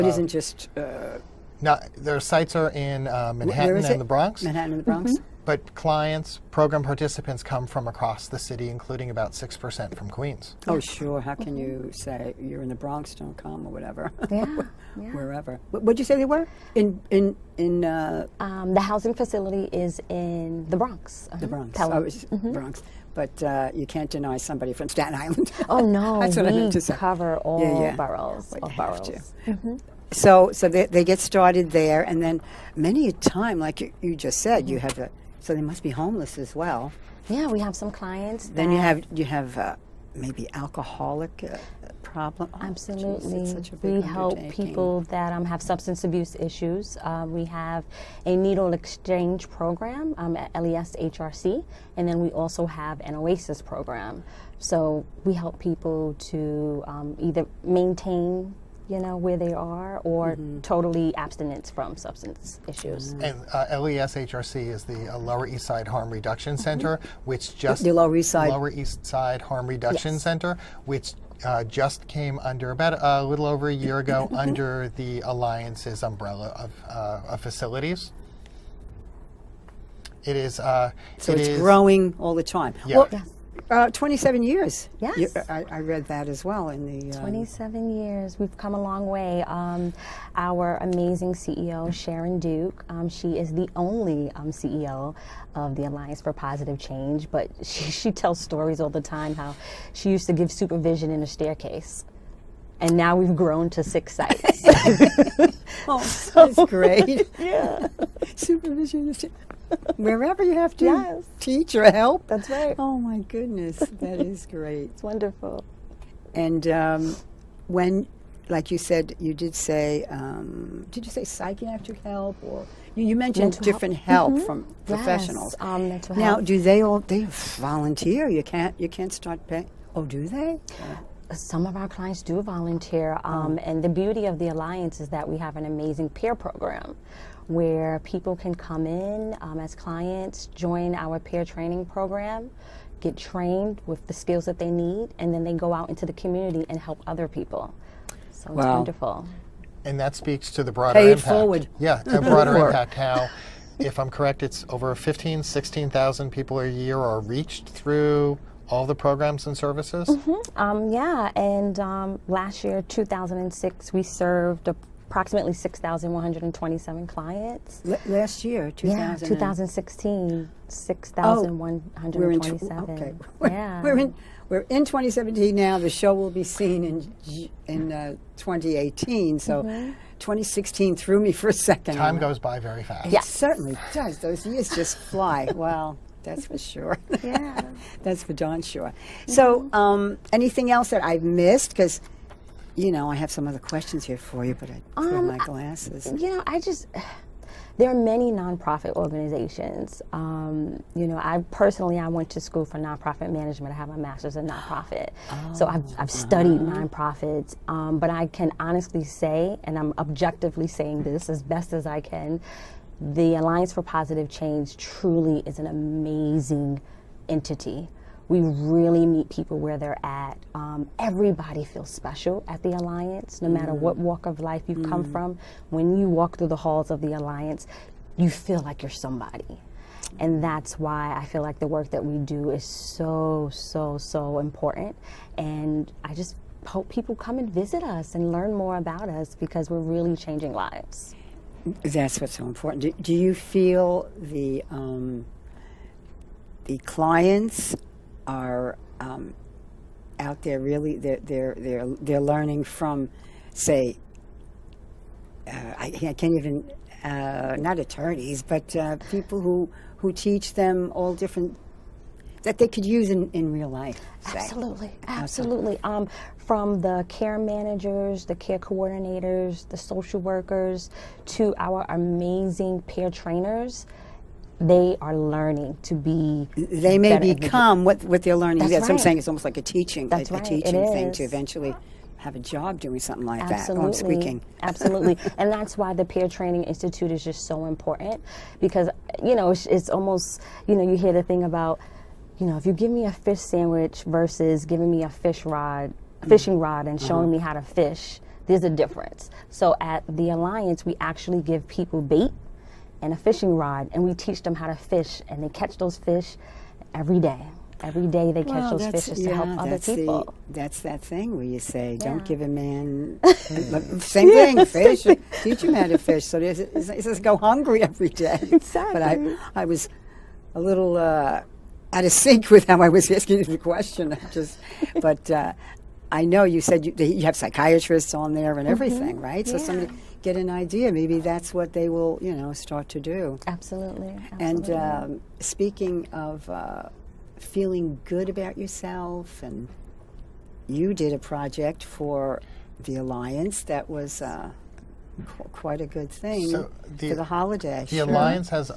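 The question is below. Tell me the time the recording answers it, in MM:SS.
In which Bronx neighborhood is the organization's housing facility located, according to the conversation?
00:21.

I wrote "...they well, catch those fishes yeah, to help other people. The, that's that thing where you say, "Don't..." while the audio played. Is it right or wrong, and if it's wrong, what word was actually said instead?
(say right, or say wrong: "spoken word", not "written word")
right.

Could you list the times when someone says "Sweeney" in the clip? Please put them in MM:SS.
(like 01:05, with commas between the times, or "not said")
not said.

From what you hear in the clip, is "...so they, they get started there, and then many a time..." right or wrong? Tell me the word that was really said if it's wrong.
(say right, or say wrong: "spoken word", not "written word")
right.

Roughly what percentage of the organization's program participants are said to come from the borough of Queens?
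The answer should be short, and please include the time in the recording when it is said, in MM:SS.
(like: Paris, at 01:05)
6%, at 00:09.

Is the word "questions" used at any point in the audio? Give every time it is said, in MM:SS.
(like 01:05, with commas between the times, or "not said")
03:13, 05:23.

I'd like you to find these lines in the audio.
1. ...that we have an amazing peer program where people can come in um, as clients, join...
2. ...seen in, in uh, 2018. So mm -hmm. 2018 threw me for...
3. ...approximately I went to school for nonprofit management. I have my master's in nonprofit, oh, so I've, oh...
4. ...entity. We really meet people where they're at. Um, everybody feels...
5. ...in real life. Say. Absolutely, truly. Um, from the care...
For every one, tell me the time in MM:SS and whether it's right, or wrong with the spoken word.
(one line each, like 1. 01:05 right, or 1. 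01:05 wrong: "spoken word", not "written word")
1. 02:15 right
2. 02:56 wrong: "2016", not "2018"
3. 03:21 wrong: "personally", not "approximately"
4. 03:37 right
5. 04:23 wrong: "absolutely", not "truly".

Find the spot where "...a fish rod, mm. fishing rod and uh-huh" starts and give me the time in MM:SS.
04:55.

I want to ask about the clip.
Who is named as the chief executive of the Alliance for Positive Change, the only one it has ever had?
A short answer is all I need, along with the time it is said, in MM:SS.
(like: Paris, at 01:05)
Sharon Duke, at 01:31.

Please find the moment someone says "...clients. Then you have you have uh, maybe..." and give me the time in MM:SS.
00:37.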